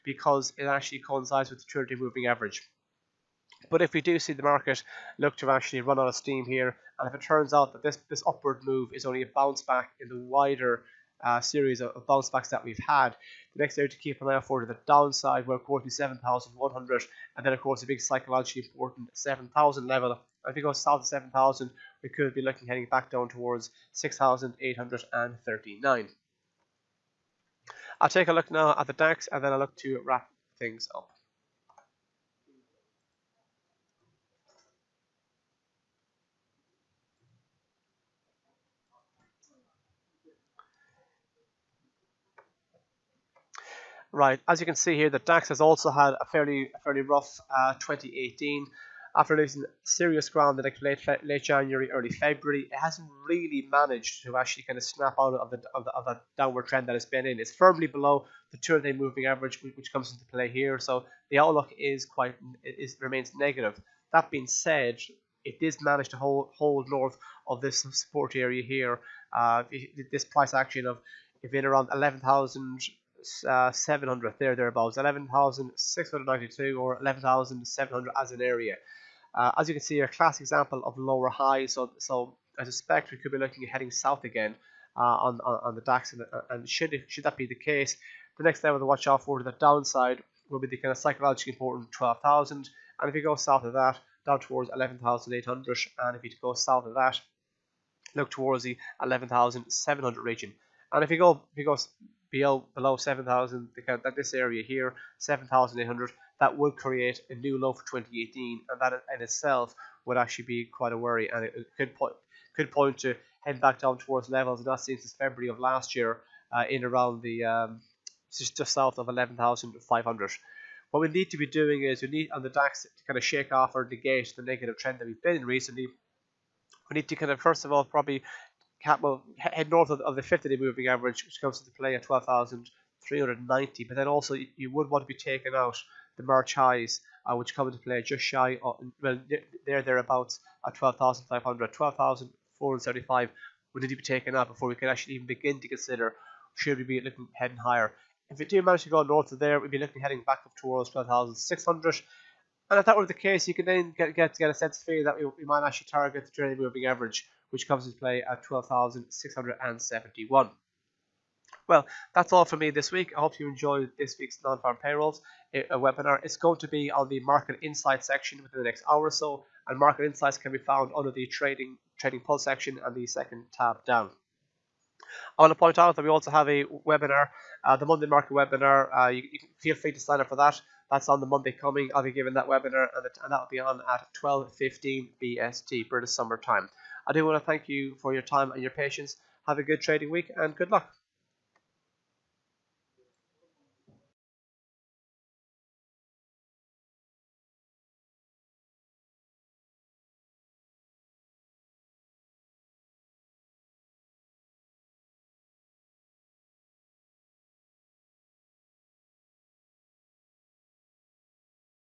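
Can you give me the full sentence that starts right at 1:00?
So the outlook is quite is remains negative.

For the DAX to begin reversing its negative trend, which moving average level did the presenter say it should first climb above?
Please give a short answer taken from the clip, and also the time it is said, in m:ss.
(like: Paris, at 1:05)
12,390, at 2:12.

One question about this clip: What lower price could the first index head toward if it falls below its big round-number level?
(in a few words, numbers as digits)
6,839.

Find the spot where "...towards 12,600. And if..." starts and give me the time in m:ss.
2:30.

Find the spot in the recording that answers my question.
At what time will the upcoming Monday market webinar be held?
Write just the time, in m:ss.
3:04.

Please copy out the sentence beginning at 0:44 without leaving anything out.
Right, as you can see here, the DAX has also had a fairly fairly rough uh, 2018.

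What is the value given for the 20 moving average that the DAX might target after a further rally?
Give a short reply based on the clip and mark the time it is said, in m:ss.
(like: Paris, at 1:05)
12,671, at 2:38.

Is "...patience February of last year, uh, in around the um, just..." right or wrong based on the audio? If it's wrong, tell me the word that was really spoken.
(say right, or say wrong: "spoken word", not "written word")
wrong: "since", not "patience".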